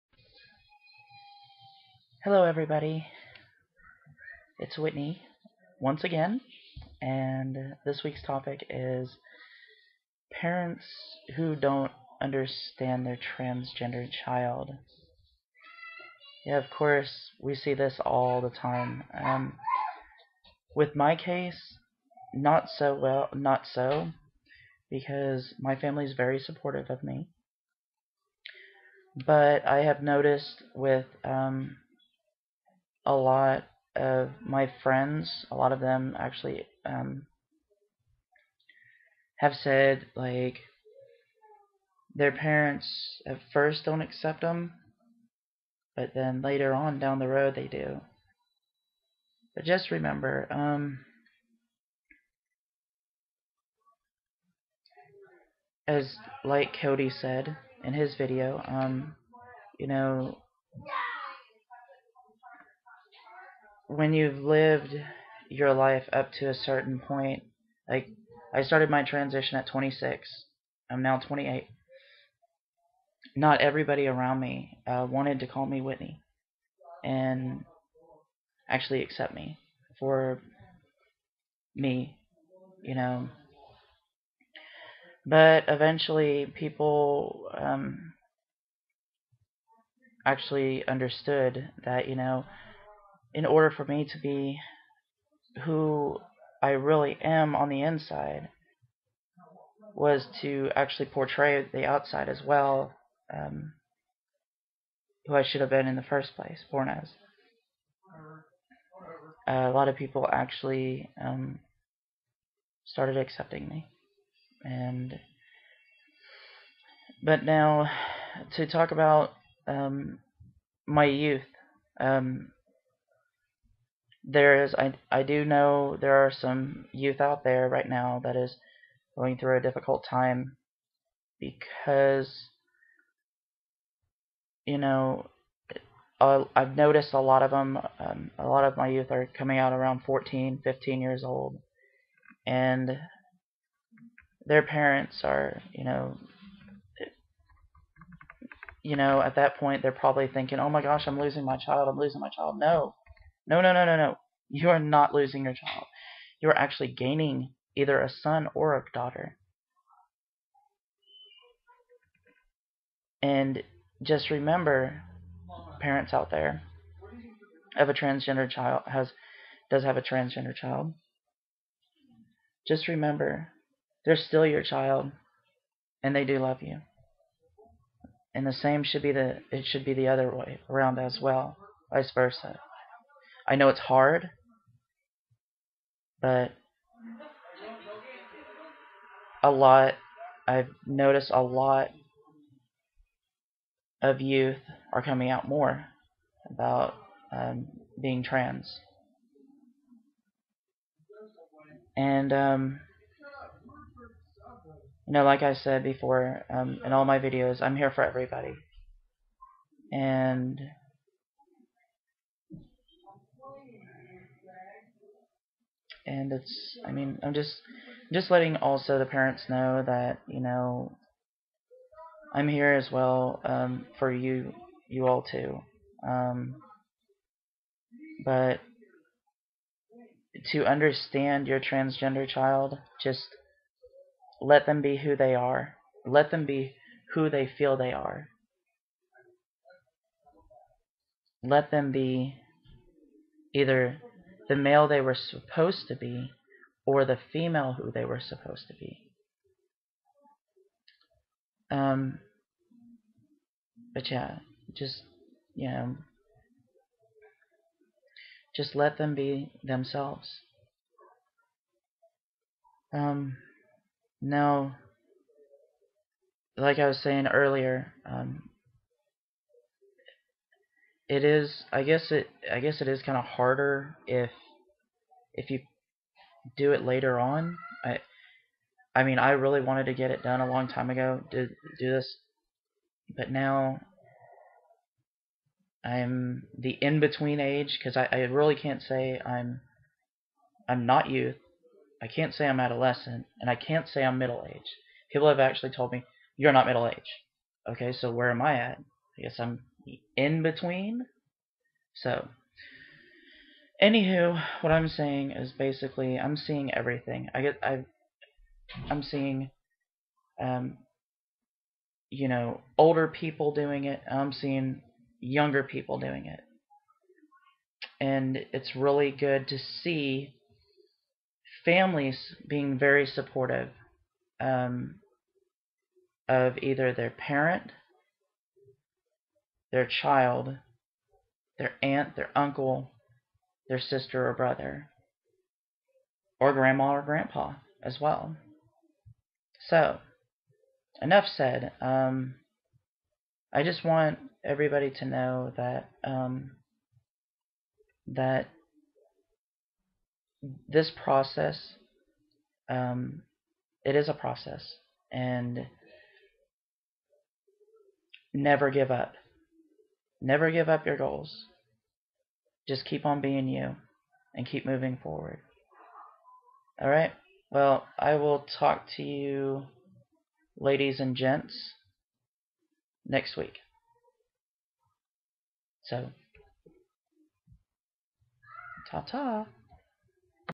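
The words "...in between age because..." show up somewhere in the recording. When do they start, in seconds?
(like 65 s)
286 s.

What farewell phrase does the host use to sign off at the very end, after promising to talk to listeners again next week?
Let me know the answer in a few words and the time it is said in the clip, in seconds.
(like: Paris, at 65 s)
Ta ta, at 378 s.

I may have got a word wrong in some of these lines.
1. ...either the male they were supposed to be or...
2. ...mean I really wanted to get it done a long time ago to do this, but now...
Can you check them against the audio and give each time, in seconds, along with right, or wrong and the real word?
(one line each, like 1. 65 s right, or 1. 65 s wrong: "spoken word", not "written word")
1. 243 s right
2. 279 s right.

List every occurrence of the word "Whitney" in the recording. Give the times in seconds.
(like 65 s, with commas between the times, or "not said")
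4 s, 75 s.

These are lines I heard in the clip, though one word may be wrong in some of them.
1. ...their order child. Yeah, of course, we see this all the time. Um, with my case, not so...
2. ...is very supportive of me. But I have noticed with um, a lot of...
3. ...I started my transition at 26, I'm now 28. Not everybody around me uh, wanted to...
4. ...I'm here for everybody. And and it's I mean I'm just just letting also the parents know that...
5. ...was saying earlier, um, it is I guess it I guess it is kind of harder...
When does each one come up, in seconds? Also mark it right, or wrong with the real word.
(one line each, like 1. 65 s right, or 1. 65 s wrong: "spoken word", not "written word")
1. 13 s wrong: "transgender", not "order"
2. 26 s right
3. 68 s right
4. 207 s right
5. 266 s right.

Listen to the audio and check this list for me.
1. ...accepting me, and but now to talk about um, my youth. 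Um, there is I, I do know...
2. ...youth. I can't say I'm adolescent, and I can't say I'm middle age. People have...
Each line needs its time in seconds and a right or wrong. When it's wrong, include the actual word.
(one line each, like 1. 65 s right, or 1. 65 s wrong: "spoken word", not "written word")
1. 113 s right
2. 291 s right.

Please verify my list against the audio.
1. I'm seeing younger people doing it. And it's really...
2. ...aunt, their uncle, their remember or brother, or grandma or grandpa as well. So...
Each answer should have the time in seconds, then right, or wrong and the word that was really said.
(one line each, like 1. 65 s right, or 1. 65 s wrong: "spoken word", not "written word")
1. 314 s right
2. 331 s wrong: "sister", not "remember".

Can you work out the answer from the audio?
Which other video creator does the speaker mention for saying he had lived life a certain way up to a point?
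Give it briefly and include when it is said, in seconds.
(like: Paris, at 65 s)
Cody, at 56 s.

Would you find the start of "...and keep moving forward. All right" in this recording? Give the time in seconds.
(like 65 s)
364 s.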